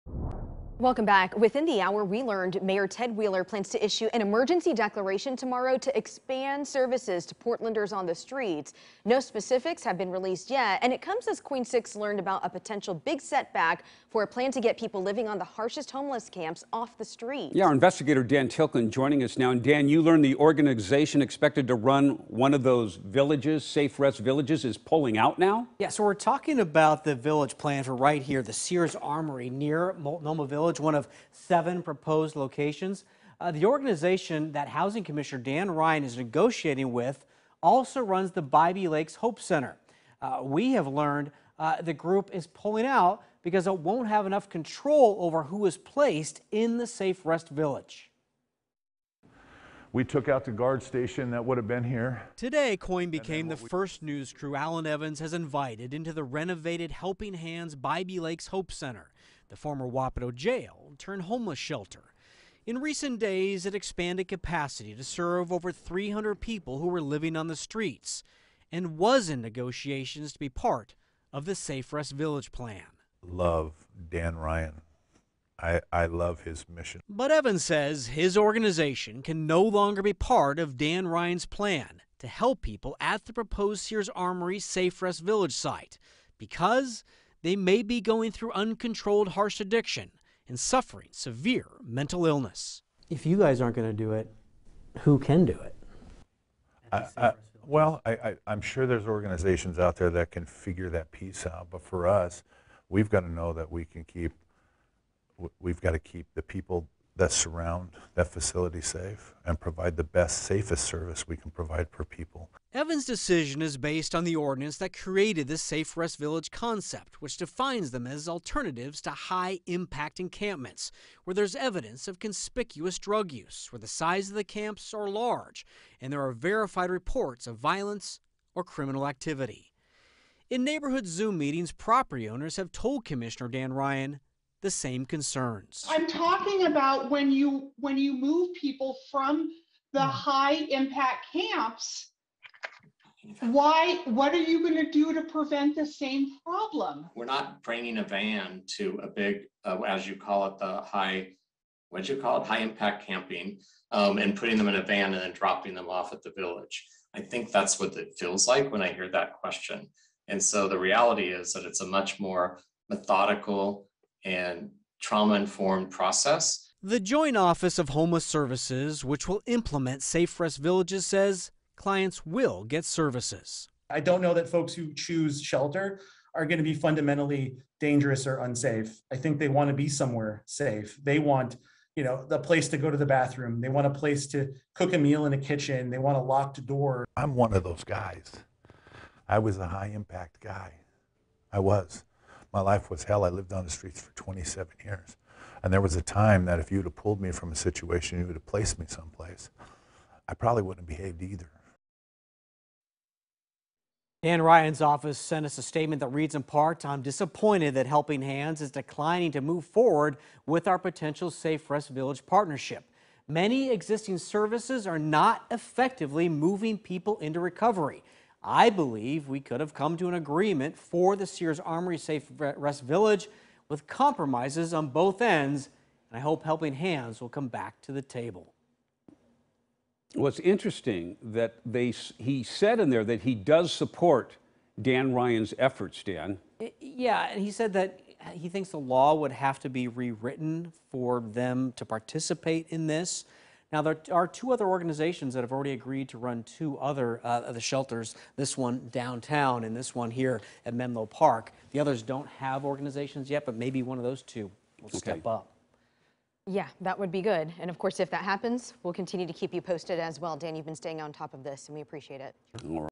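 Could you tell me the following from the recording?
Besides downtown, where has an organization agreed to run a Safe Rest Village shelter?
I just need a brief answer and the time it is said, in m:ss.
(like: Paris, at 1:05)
Menlo Park, at 4:10.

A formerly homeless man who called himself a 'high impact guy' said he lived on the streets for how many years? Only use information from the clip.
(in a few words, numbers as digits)
27.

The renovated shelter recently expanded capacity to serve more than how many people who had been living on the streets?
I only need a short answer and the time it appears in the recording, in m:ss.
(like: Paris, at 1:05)
300, at 1:05.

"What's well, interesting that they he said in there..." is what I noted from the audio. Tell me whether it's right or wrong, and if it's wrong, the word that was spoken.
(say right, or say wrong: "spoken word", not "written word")
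right.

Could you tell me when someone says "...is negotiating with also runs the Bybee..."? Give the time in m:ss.
0:36.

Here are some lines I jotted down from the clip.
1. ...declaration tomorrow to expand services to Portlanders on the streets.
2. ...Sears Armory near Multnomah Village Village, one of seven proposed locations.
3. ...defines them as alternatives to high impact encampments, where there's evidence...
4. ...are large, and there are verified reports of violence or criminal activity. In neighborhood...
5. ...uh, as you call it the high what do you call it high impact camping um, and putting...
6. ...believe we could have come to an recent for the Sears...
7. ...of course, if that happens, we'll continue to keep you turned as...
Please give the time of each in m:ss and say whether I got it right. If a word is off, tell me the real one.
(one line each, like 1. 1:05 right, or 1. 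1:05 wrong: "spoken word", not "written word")
1. 0:04 right
2. 0:28 right
3. 1:57 right
4. 2:04 right
5. 2:29 right
6. 3:38 wrong: "agreement", not "recent"
7. 4:17 wrong: "posted", not "turned".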